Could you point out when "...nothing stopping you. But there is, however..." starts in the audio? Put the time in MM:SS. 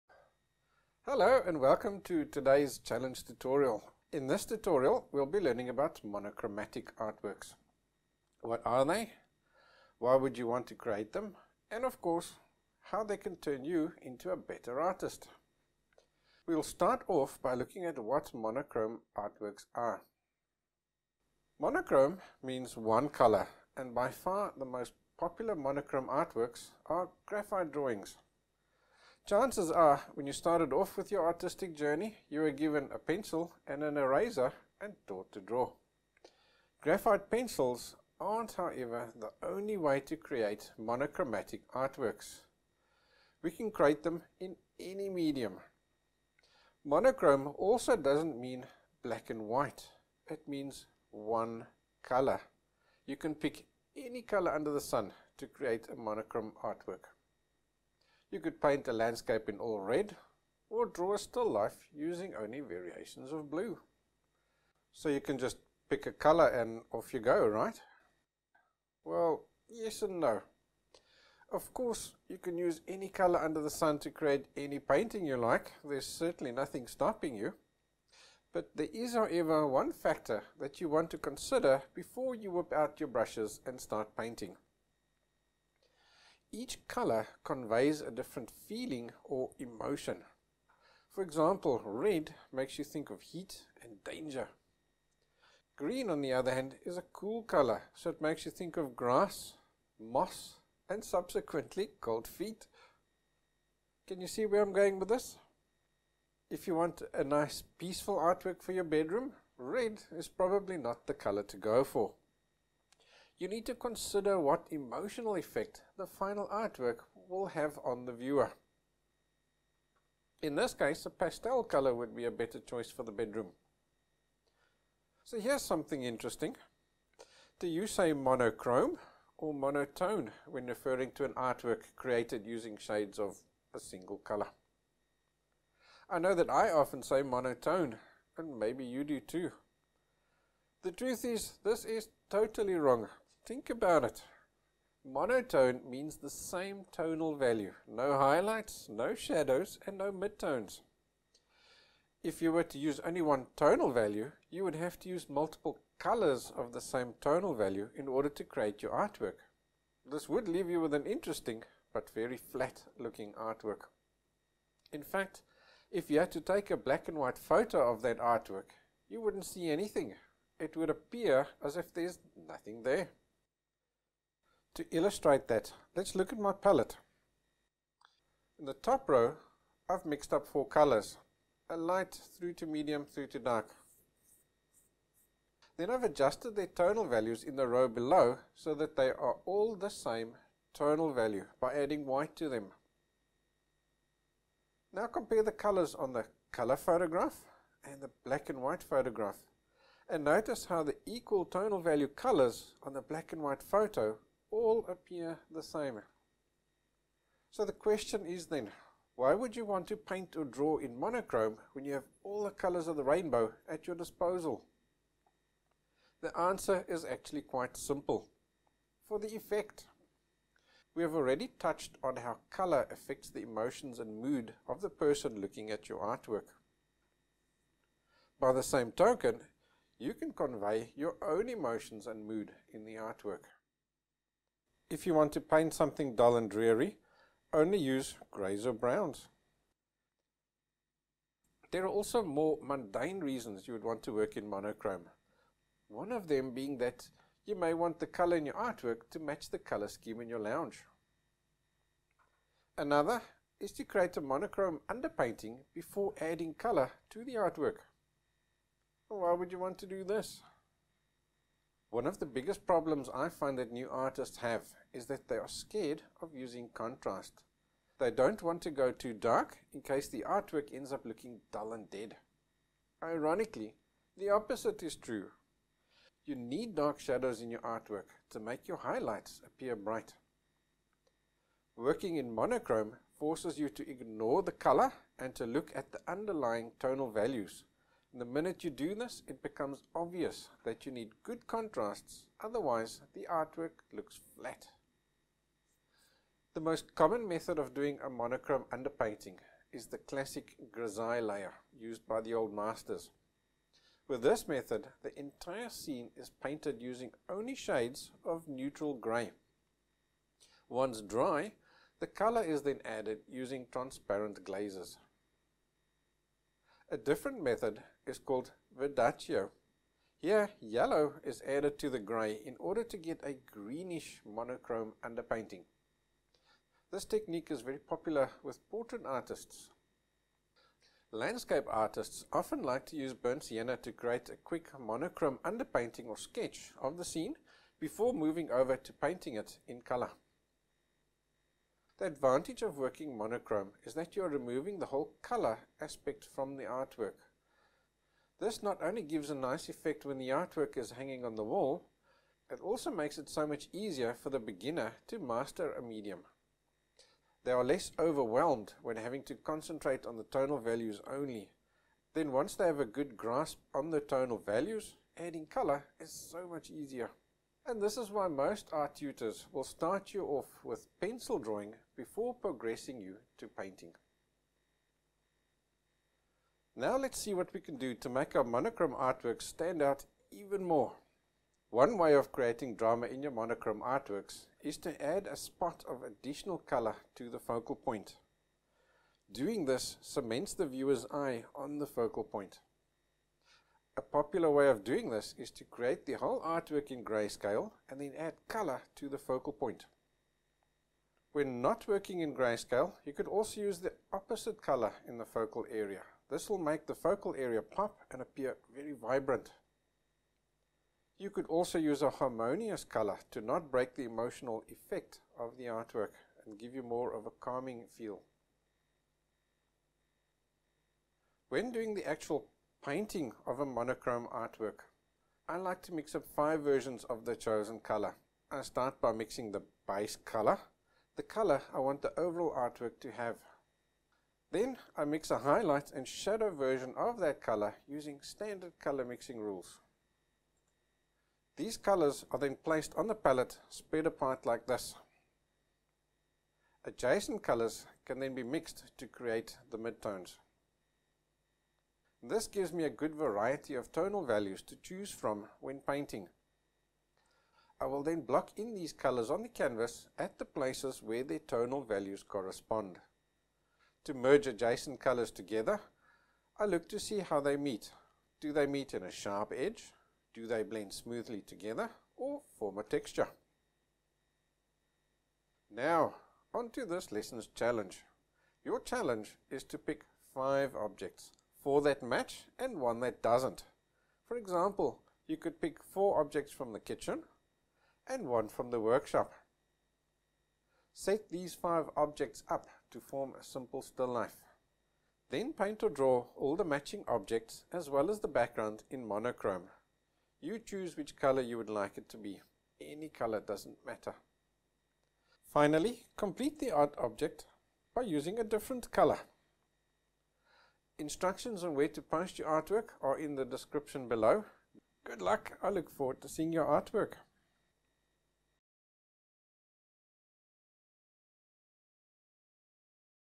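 01:16.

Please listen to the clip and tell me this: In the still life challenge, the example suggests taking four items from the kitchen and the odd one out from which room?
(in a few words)
The workshop.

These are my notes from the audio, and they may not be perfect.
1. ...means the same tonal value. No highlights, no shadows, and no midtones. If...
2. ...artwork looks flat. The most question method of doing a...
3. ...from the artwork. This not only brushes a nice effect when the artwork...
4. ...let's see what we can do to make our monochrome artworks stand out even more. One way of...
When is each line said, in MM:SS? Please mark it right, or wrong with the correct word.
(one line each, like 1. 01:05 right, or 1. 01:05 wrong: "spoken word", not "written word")
1. 02:25 right
2. 04:53 wrong: "common", not "question"
3. 05:46 wrong: "gives", not "brushes"
4. 06:16 right.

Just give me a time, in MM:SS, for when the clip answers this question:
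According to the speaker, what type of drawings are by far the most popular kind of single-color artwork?
00:27.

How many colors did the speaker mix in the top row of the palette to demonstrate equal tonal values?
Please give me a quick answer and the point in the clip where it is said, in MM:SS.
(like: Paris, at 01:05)
4, at 03:00.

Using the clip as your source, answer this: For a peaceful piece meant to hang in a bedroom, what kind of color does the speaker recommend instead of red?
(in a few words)
A pastel color.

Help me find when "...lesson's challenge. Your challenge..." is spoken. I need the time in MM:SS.
07:57.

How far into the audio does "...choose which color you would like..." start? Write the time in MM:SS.
08:20.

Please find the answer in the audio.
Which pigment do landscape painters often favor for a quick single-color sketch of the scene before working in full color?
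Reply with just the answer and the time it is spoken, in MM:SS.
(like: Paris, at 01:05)
Burnt sienna, at 05:33.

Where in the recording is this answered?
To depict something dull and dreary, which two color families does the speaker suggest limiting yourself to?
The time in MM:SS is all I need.
03:58.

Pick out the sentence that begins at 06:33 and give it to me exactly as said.
A popular way of doing this is to create the whole artwork in grayscale and then add color to the focal point.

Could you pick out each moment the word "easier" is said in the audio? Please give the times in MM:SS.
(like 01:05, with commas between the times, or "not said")
05:53, 06:06.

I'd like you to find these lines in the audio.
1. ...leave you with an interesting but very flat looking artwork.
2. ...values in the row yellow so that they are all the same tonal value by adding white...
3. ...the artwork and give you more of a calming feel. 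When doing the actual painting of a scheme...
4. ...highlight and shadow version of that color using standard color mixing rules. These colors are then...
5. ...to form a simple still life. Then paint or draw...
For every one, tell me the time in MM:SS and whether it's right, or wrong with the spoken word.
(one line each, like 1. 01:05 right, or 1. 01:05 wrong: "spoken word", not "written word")
1. 02:40 right
2. 03:07 wrong: "below", not "yellow"
3. 06:55 wrong: "monochrome", not "scheme"
4. 07:15 right
5. 08:12 right.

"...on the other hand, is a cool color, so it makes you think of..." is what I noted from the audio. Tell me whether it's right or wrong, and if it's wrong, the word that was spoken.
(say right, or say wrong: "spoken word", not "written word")
right.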